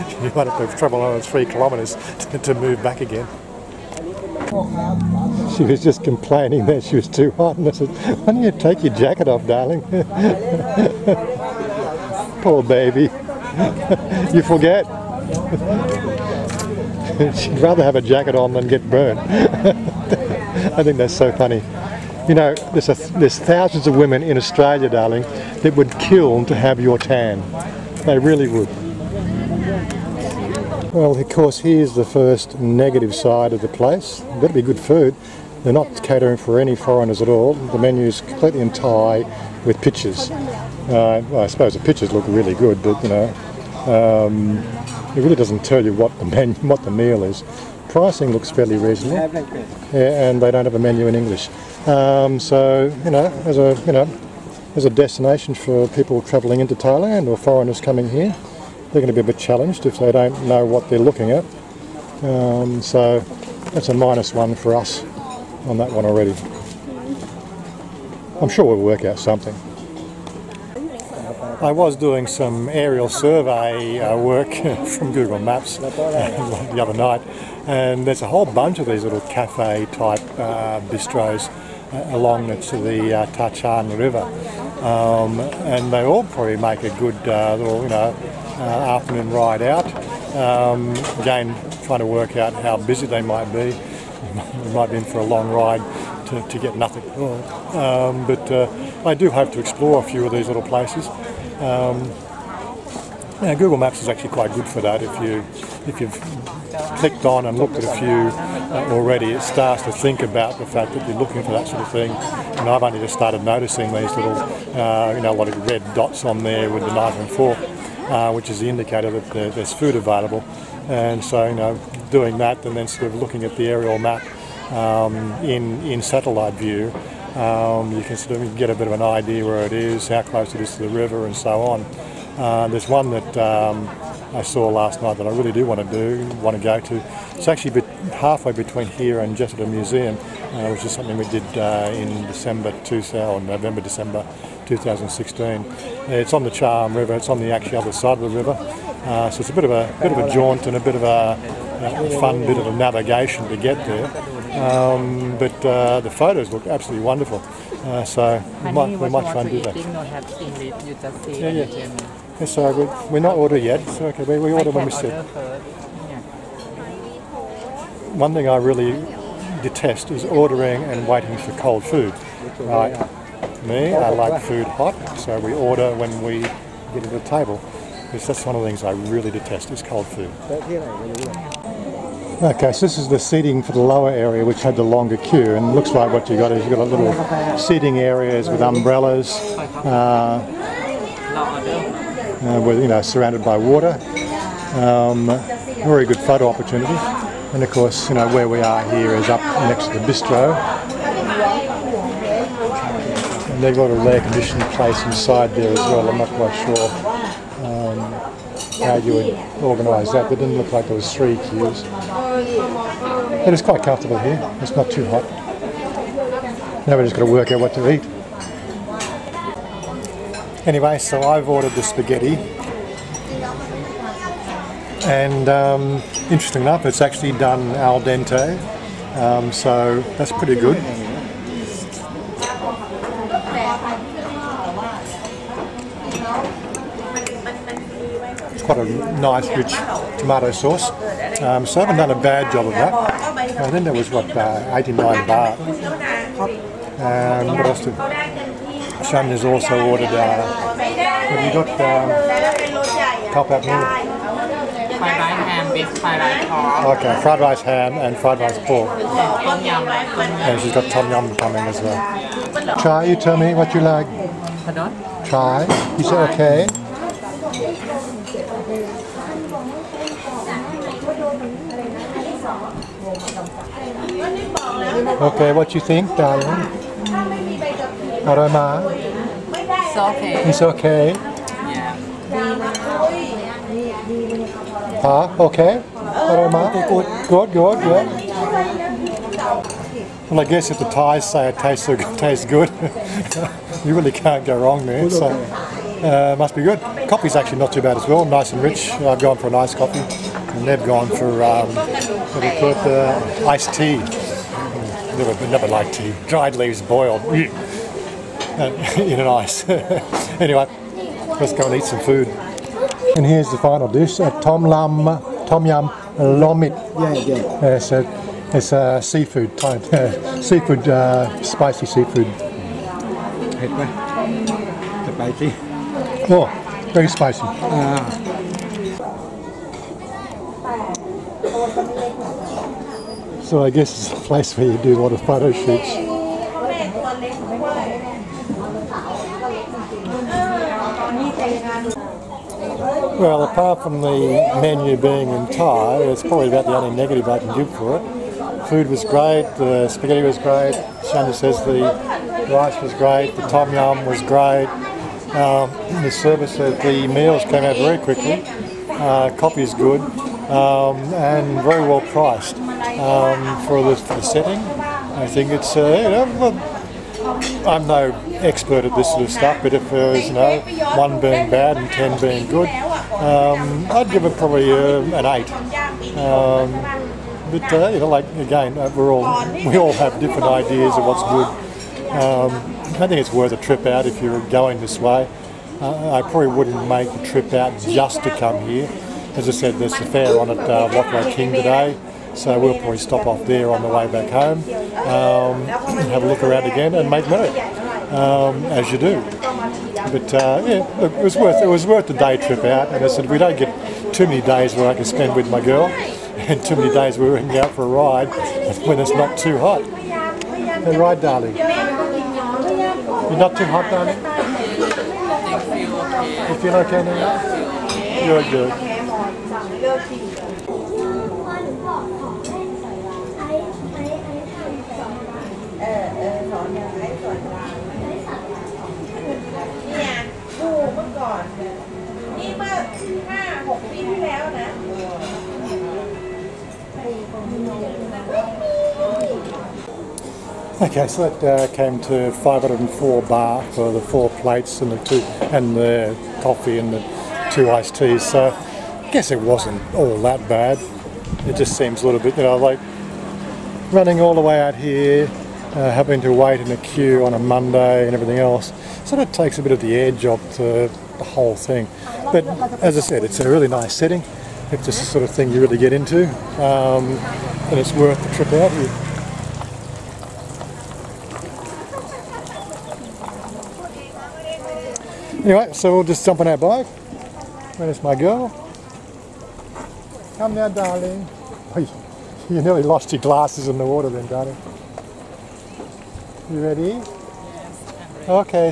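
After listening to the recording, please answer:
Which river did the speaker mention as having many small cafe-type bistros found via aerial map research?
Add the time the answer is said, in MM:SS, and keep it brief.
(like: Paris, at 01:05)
Tha Chin River, at 01:23.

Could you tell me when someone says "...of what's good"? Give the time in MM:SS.
06:20.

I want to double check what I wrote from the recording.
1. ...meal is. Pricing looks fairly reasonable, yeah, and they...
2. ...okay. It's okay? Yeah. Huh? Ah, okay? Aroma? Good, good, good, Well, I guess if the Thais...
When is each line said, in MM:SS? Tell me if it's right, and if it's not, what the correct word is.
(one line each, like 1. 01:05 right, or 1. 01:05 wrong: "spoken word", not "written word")
1. 00:46 right
2. 04:39 right.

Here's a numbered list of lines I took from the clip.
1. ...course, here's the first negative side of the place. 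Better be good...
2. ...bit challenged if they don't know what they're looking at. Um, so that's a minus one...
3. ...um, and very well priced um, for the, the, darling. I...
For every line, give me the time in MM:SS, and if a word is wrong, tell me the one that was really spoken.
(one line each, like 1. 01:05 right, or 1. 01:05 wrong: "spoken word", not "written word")
1. 00:31 right
2. 00:59 right
3. 06:00 wrong: "setting", not "darling".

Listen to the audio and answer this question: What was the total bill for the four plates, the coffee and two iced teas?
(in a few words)
504 baht.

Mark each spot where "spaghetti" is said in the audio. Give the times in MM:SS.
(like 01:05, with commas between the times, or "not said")
03:41, 05:49.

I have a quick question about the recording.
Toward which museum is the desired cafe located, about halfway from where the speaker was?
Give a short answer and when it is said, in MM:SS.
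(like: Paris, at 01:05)
Jesada Museum, at 02:19.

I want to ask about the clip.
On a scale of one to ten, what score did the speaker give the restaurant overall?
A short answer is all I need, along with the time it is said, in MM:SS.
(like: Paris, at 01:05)
8, at 06:15.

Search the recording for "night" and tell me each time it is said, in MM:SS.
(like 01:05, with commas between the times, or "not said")
01:16, 02:15.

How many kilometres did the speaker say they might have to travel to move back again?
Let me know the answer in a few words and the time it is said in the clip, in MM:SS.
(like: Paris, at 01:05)
3 kilometres, at 00:01.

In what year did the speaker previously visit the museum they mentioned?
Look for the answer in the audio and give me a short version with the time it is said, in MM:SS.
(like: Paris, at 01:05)
2016, at 02:24.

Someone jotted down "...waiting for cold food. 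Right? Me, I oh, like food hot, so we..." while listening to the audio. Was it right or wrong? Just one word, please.
right.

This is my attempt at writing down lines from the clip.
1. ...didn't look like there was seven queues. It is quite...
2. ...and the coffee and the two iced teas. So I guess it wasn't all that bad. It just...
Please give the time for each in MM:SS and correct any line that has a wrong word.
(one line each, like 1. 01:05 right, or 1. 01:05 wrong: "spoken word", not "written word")
1. 03:30 wrong: "three", not "seven"
2. 07:25 right.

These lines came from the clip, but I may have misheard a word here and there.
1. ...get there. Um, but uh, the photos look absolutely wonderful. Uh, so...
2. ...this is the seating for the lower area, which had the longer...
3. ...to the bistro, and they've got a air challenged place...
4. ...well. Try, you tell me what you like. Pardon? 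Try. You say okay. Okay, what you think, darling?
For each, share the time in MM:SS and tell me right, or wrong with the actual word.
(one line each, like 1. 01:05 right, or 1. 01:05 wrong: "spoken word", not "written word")
1. 02:33 right
2. 03:02 right
3. 03:19 wrong: "conditioned", not "challenged"
4. 04:21 right.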